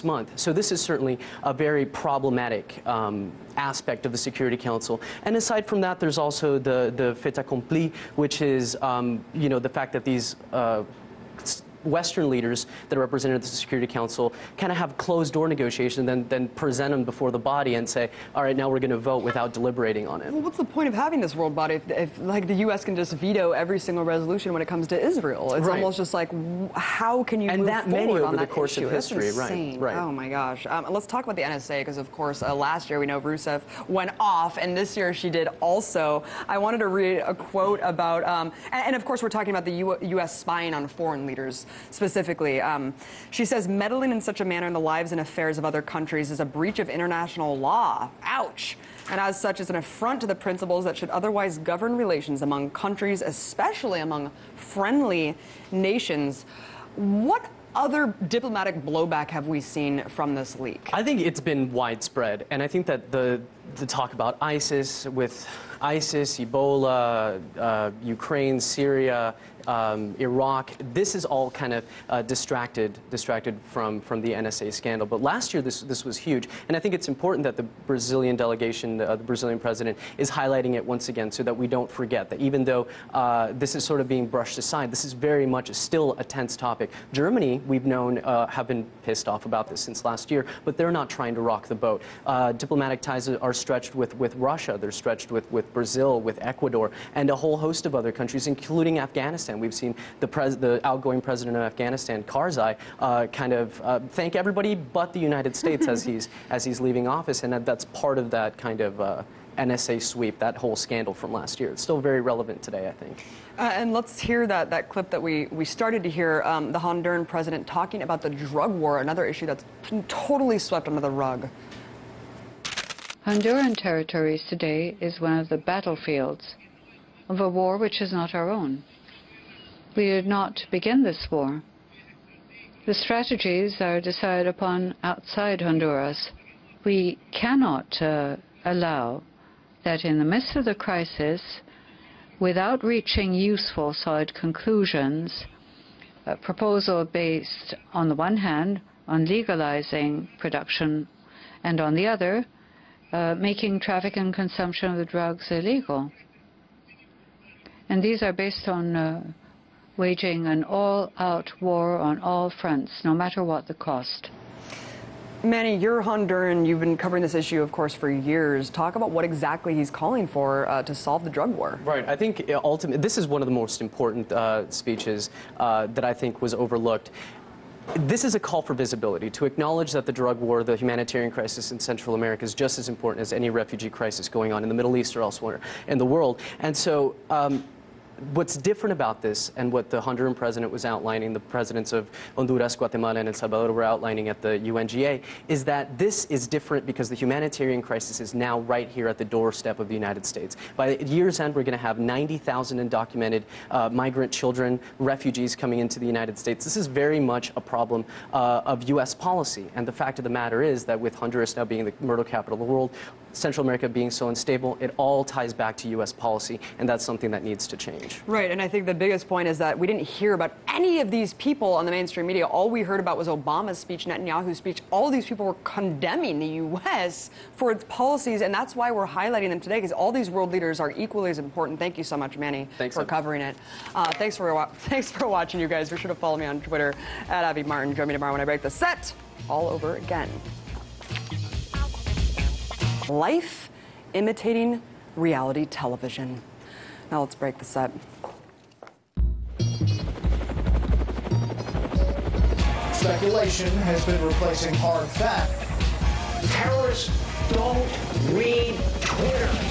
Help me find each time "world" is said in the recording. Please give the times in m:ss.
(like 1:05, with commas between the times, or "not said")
0:21, 3:06, 3:32, 3:50.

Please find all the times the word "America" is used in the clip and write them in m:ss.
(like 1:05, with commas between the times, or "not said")
3:02, 3:33.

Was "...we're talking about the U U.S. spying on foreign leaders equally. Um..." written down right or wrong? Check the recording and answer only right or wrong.
wrong.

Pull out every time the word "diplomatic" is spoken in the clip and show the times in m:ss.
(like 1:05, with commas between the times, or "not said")
0:58, 1:32.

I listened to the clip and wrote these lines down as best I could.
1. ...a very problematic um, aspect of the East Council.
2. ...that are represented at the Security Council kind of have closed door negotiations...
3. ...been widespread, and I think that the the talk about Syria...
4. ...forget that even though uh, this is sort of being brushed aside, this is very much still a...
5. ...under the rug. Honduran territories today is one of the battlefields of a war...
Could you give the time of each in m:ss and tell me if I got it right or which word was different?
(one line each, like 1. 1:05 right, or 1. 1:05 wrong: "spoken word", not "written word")
1. 0:01 wrong: "Security", not "East"
2. 0:12 right
3. 1:01 wrong: "ISIS", not "Syria"
4. 1:21 right
5. 2:00 right.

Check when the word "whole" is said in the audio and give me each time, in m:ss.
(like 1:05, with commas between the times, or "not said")
1:37, 1:50.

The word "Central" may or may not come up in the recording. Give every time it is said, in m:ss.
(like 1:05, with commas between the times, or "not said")
3:01, 3:33.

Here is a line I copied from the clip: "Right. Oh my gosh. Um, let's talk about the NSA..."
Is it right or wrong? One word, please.
right.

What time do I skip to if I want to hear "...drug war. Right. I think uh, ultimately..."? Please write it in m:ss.
2:51.